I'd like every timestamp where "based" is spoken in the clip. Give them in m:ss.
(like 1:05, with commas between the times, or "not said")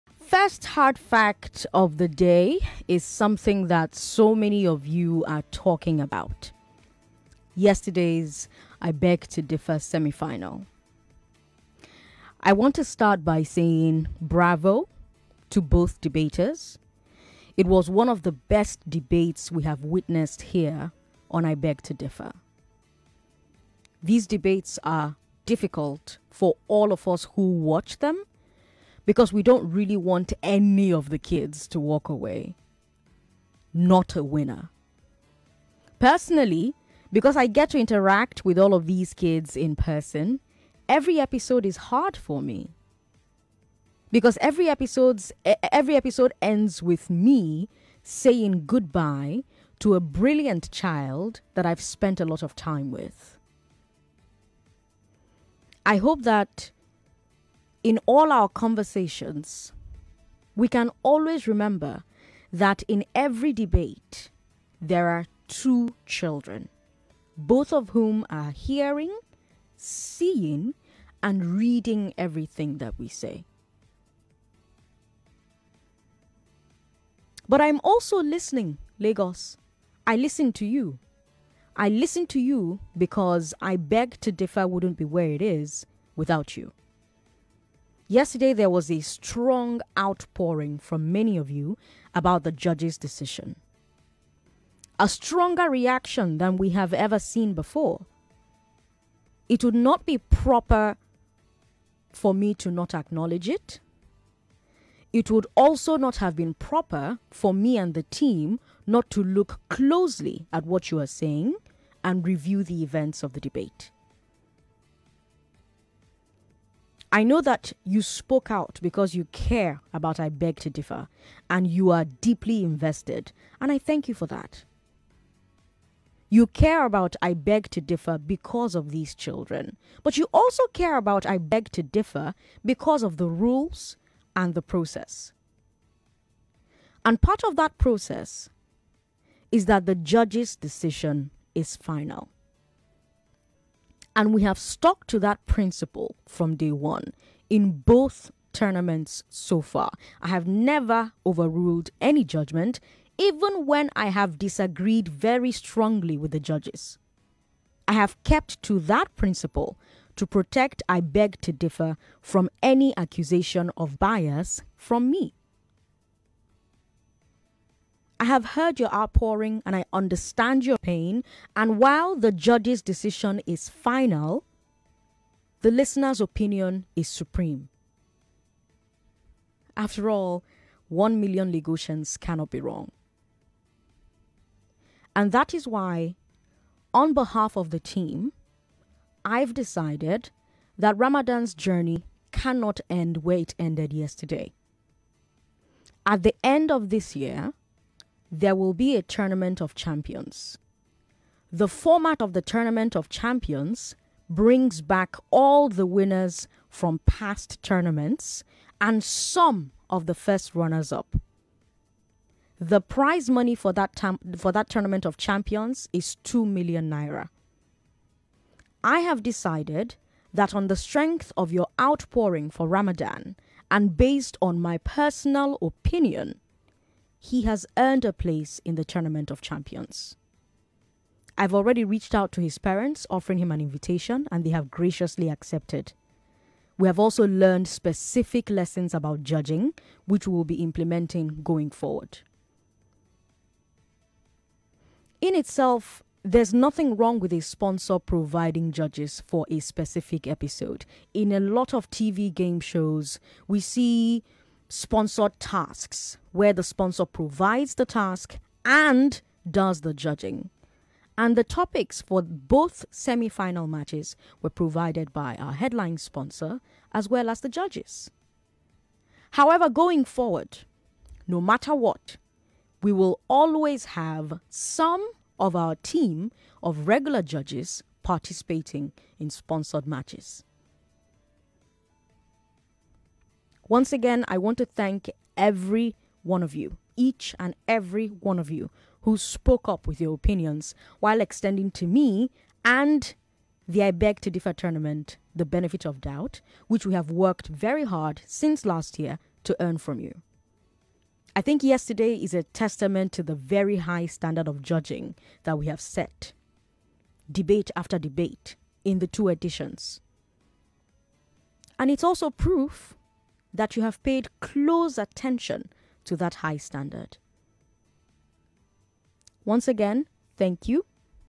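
3:43.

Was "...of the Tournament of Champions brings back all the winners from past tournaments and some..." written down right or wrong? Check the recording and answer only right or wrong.
right.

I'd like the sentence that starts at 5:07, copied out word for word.
Debate after debate in the two editions.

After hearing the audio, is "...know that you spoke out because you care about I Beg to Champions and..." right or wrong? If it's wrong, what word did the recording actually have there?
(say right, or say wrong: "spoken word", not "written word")
wrong: "Differ", not "Champions".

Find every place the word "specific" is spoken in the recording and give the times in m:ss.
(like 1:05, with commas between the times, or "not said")
3:57, 4:09.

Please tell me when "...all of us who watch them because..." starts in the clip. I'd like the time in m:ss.
0:26.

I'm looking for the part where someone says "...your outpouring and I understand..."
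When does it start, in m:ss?
2:48.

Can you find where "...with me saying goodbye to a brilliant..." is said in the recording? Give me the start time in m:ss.
0:46.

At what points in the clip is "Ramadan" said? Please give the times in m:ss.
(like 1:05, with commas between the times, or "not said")
3:10, 3:42.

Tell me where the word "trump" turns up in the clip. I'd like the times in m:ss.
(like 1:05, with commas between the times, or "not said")
not said.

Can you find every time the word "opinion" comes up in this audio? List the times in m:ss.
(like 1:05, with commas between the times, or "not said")
2:56, 3:45, 4:50.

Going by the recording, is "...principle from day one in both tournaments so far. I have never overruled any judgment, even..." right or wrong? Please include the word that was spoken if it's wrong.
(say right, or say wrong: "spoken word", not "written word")
right.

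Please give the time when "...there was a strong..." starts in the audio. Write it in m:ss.
1:28.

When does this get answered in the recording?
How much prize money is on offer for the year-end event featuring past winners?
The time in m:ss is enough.
3:36.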